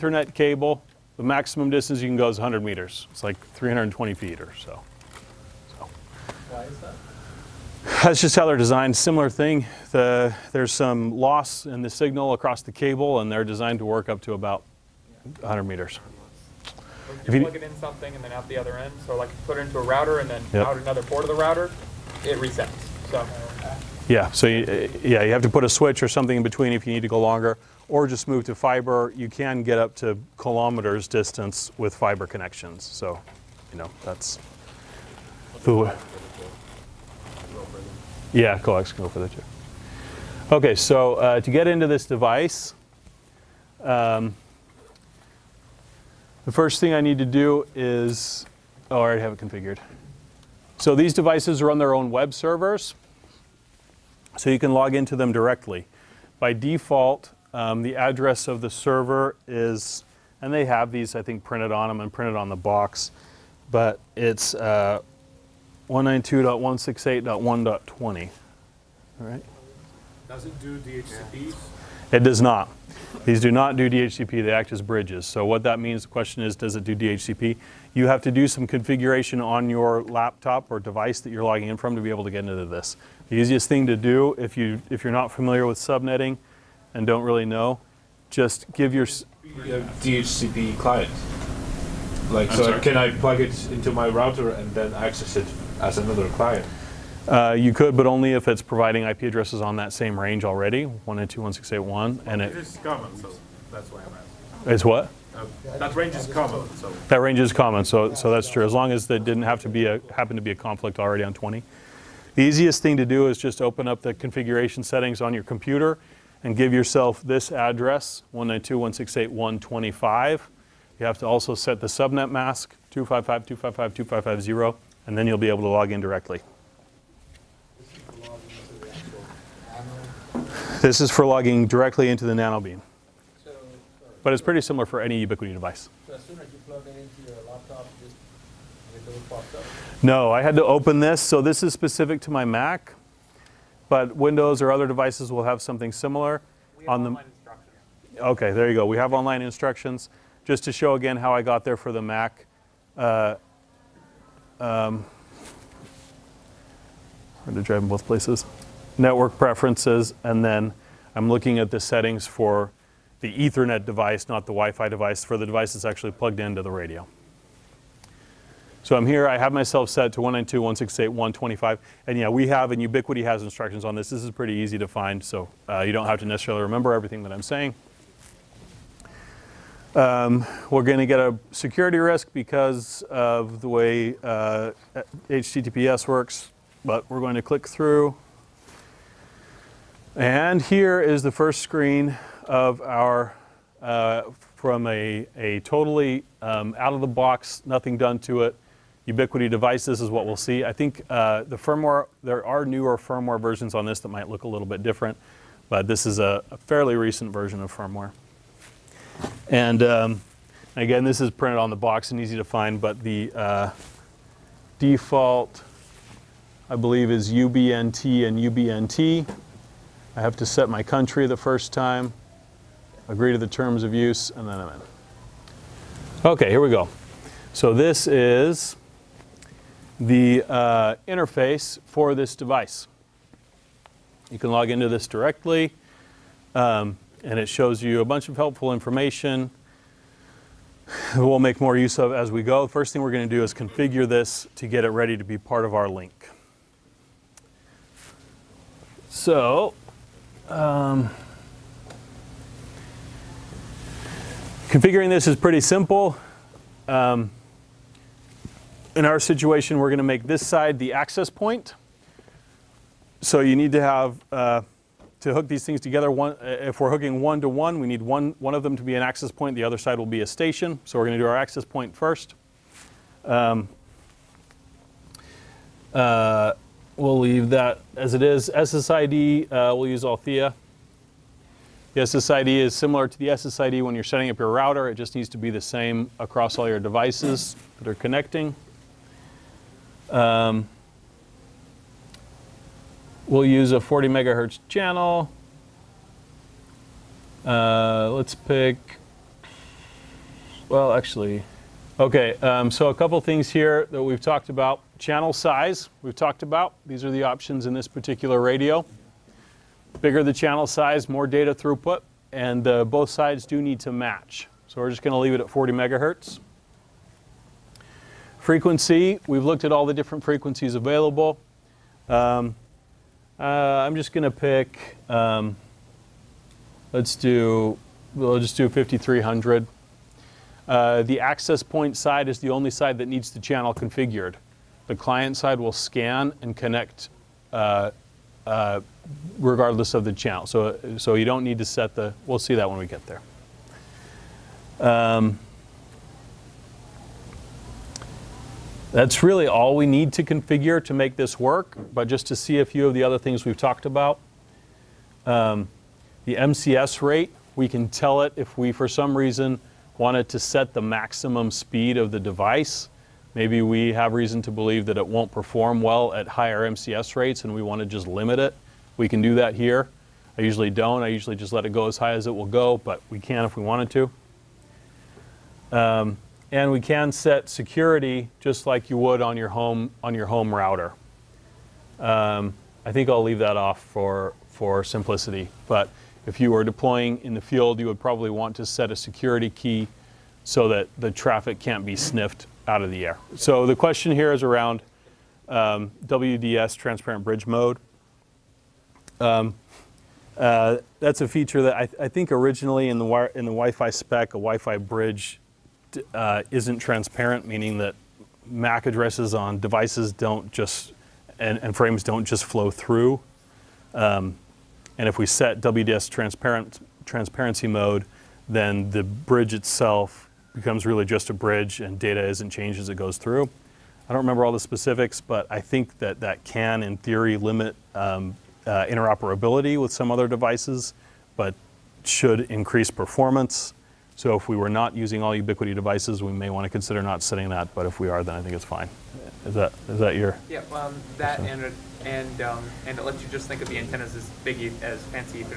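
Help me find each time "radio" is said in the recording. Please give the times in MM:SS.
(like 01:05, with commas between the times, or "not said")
02:46, 05:08.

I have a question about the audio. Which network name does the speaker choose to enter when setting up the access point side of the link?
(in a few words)
Althea.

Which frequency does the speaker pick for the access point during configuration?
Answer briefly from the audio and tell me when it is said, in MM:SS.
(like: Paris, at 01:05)
5300, at 05:28.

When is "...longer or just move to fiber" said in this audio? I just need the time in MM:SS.
00:27.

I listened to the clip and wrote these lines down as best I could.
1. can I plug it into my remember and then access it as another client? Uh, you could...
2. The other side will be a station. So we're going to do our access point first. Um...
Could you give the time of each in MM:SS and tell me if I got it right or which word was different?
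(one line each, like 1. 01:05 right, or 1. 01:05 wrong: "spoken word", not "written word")
1. 01:32 wrong: "router", not "remember"
2. 04:29 right.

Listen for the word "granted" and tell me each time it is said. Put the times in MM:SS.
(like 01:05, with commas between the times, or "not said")
not said.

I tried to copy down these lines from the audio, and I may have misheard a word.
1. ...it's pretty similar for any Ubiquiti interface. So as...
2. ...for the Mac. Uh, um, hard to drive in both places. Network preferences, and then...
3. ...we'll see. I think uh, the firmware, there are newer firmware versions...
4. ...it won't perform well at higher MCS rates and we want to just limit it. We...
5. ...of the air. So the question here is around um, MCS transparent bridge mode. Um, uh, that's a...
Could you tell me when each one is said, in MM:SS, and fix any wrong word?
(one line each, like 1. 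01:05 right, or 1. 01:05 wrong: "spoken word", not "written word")
1. 02:14 wrong: "device", not "interface"
2. 02:31 right
3. 03:20 right
4. 06:04 right
5. 06:32 wrong: "WDS", not "MCS".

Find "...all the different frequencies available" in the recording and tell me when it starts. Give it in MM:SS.
05:19.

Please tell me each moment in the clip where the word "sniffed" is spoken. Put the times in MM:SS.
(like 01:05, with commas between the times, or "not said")
06:31.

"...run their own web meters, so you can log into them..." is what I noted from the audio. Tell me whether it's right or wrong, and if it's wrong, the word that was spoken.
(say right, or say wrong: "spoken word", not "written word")
wrong: "servers", not "meters".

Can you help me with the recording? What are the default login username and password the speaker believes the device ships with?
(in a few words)
UBNT and UBNT.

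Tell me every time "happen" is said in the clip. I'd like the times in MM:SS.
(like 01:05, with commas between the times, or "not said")
01:50.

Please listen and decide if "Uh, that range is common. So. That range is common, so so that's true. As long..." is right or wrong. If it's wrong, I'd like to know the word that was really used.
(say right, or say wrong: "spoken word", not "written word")
right.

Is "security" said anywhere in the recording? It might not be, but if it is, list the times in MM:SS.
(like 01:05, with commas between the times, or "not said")
03:01, 06:17, 06:28.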